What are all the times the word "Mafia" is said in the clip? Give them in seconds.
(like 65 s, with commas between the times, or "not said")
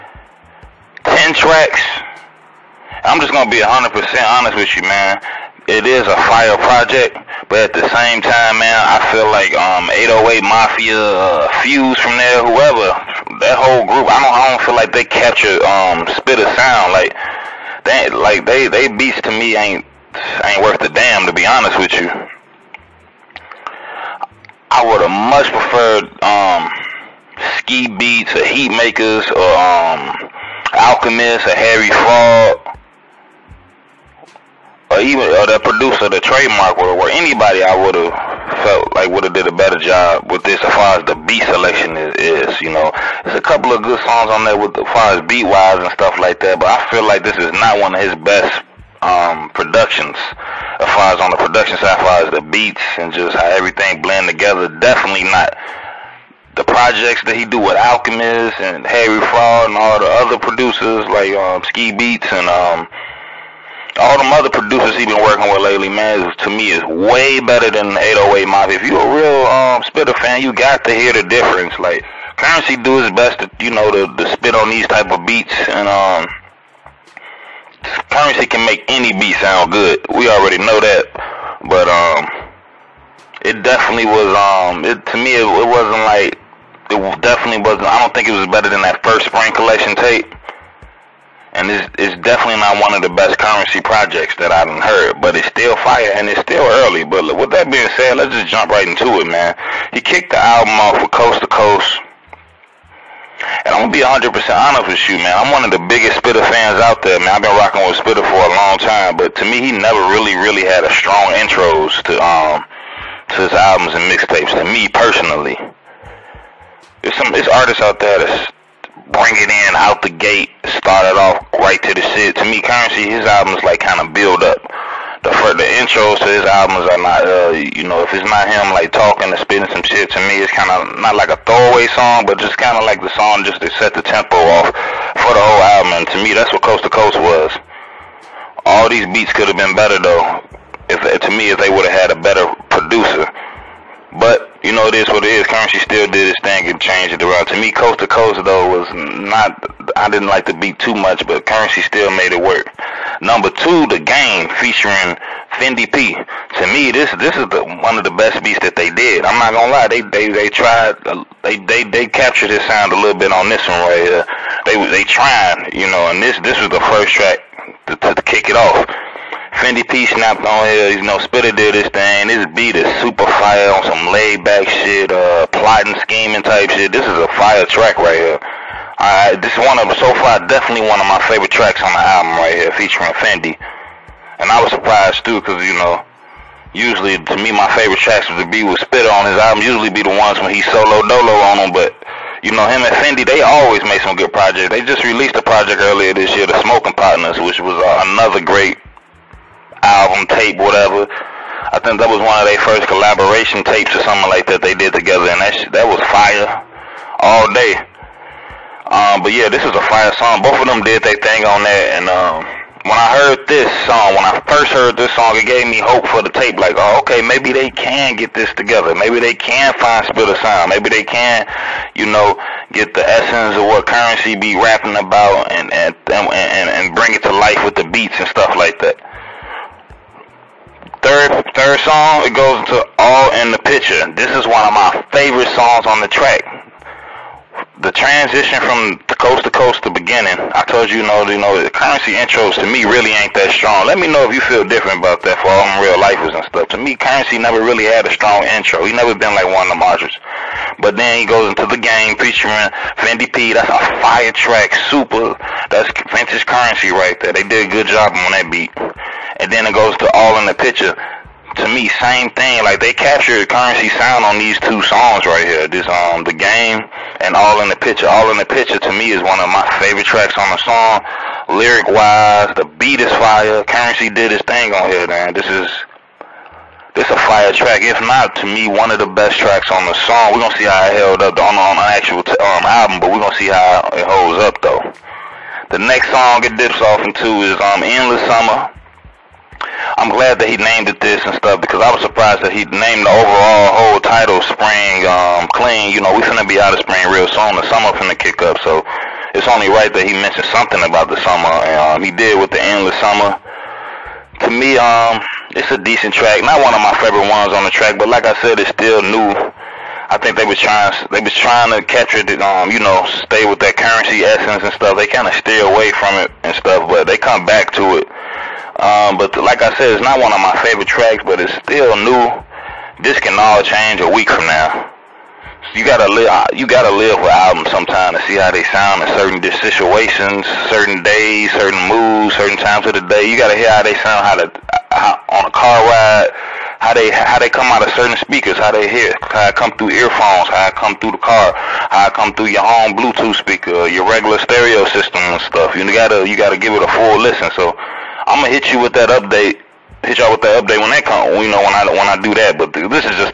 10 s, 68 s.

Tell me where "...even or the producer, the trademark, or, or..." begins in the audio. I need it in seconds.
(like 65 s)
35 s.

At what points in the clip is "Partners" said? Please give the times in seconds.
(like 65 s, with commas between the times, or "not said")
196 s.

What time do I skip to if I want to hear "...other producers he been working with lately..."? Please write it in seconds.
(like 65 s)
64 s.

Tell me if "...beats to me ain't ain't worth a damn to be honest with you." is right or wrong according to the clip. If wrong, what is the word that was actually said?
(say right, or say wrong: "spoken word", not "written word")
right.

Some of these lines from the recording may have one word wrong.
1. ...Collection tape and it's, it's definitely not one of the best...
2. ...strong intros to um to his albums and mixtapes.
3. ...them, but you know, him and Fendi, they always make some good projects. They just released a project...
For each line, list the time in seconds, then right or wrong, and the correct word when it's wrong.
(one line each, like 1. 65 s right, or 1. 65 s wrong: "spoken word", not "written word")
1. 89 s right
2. 110 s right
3. 191 s right.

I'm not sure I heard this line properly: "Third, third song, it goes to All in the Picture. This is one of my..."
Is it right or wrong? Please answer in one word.
right.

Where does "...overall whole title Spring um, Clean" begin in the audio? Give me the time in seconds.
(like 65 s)
293 s.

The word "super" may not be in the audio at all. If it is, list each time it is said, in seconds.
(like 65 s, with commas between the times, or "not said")
173 s, 254 s.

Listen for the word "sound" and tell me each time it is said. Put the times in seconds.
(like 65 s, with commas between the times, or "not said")
16 s, 79 s, 162 s, 220 s, 263 s, 328 s, 333 s.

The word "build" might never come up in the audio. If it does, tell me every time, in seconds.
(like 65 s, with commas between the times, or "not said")
124 s.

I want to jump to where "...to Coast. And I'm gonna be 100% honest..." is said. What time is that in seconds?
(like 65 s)
101 s.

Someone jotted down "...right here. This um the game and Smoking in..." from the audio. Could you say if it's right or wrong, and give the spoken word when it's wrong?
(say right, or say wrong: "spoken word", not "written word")
wrong: "All", not "Smoking".